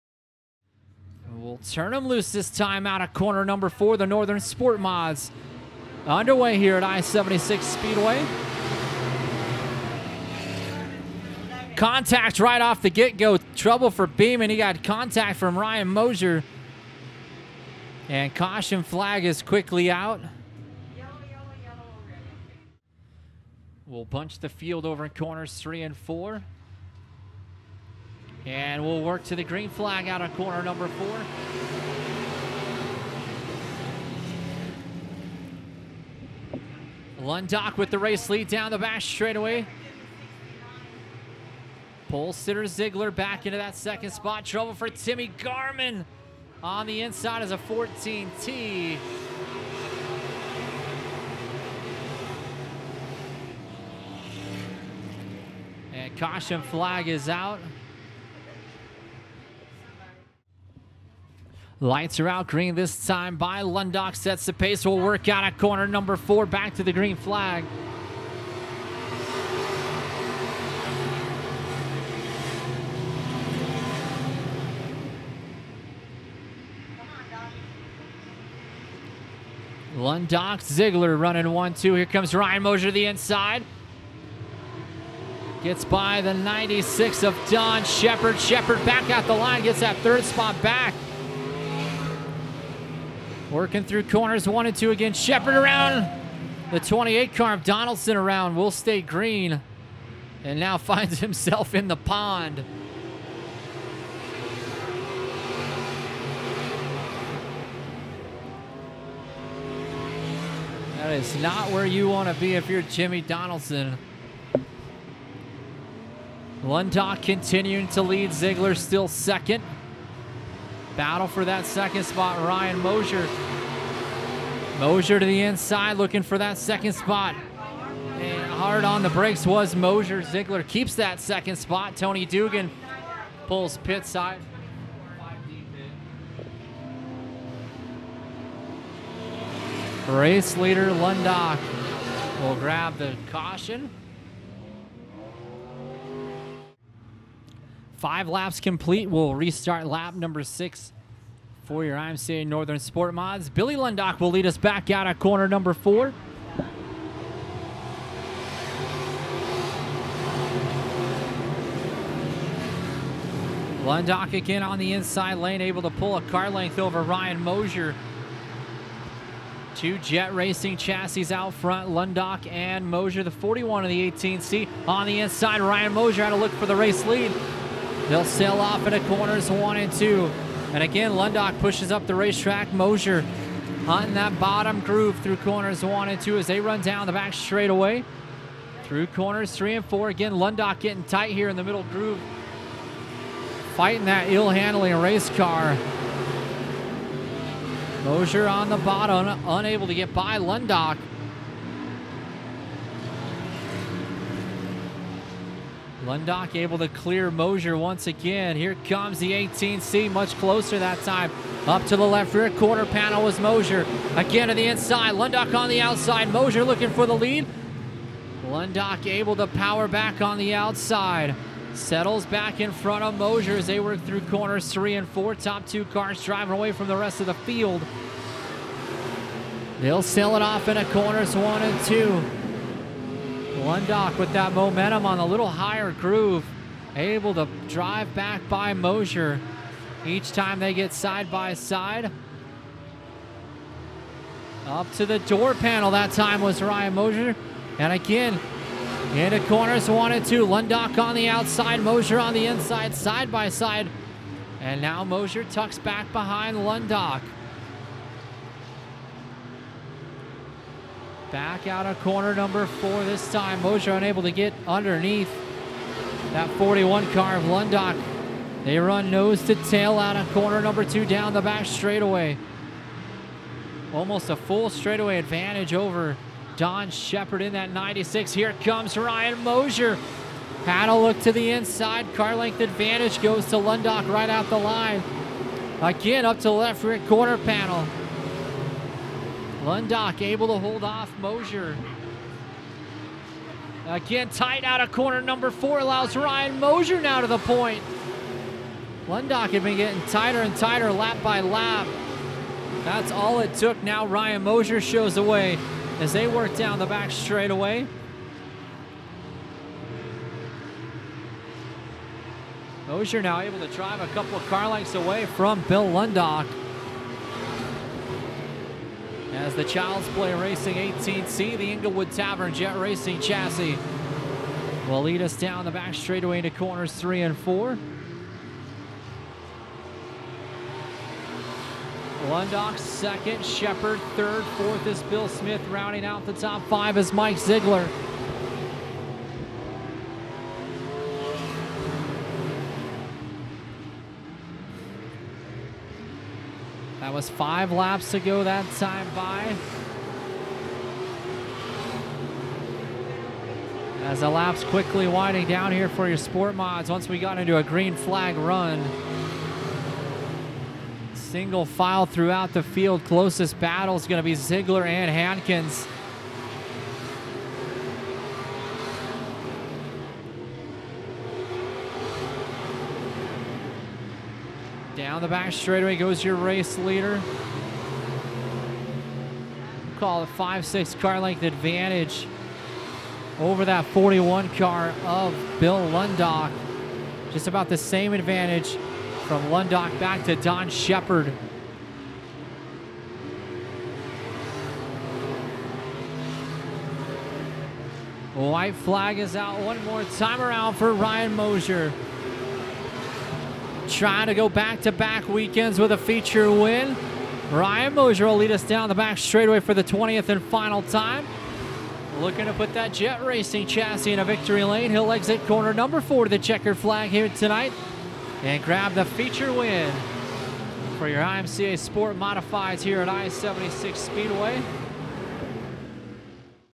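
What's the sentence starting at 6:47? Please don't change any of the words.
Ryan Mosier will lead us down the back straightaway for the 20th and final time.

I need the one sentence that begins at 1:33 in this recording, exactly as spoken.
Working through corners one and two again.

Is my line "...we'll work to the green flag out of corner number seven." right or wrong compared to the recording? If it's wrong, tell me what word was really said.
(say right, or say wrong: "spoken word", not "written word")
wrong: "four", not "seven".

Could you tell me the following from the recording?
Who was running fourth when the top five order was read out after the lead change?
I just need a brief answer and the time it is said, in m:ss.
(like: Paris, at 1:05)
Bill Smith, at 5:35.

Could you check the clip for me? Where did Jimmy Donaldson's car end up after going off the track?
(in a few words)
In the pond.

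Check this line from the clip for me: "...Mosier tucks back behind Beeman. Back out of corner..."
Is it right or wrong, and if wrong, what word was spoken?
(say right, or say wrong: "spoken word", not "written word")
wrong: "Lundock", not "Beeman".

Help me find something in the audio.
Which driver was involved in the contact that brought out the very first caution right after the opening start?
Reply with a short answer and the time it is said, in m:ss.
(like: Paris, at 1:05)
Beeman, at 0:14.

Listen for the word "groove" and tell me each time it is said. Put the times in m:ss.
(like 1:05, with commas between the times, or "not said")
3:04, 3:11, 3:55.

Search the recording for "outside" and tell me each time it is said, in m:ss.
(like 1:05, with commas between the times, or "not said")
3:35, 3:40, 4:11.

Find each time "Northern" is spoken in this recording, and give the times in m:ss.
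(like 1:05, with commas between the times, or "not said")
0:04, 2:32.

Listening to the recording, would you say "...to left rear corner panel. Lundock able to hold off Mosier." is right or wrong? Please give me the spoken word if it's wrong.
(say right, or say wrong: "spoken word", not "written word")
right.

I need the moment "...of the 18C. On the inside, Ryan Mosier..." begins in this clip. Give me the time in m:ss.
2:53.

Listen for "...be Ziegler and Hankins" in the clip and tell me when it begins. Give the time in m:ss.
6:04.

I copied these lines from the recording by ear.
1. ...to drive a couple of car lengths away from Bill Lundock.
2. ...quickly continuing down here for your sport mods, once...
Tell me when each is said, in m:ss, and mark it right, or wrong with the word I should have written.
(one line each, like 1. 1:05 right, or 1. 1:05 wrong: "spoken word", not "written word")
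1. 5:13 right
2. 5:54 wrong: "winding", not "continuing".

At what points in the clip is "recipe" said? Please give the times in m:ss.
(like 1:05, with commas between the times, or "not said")
not said.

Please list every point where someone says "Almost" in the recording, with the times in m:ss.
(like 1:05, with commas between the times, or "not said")
4:33.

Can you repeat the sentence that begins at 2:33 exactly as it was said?
Billy Lundock will lead us back out of corner number four.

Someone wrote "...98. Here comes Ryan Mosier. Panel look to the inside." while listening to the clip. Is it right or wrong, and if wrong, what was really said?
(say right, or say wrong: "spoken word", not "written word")
wrong: "96", not "98".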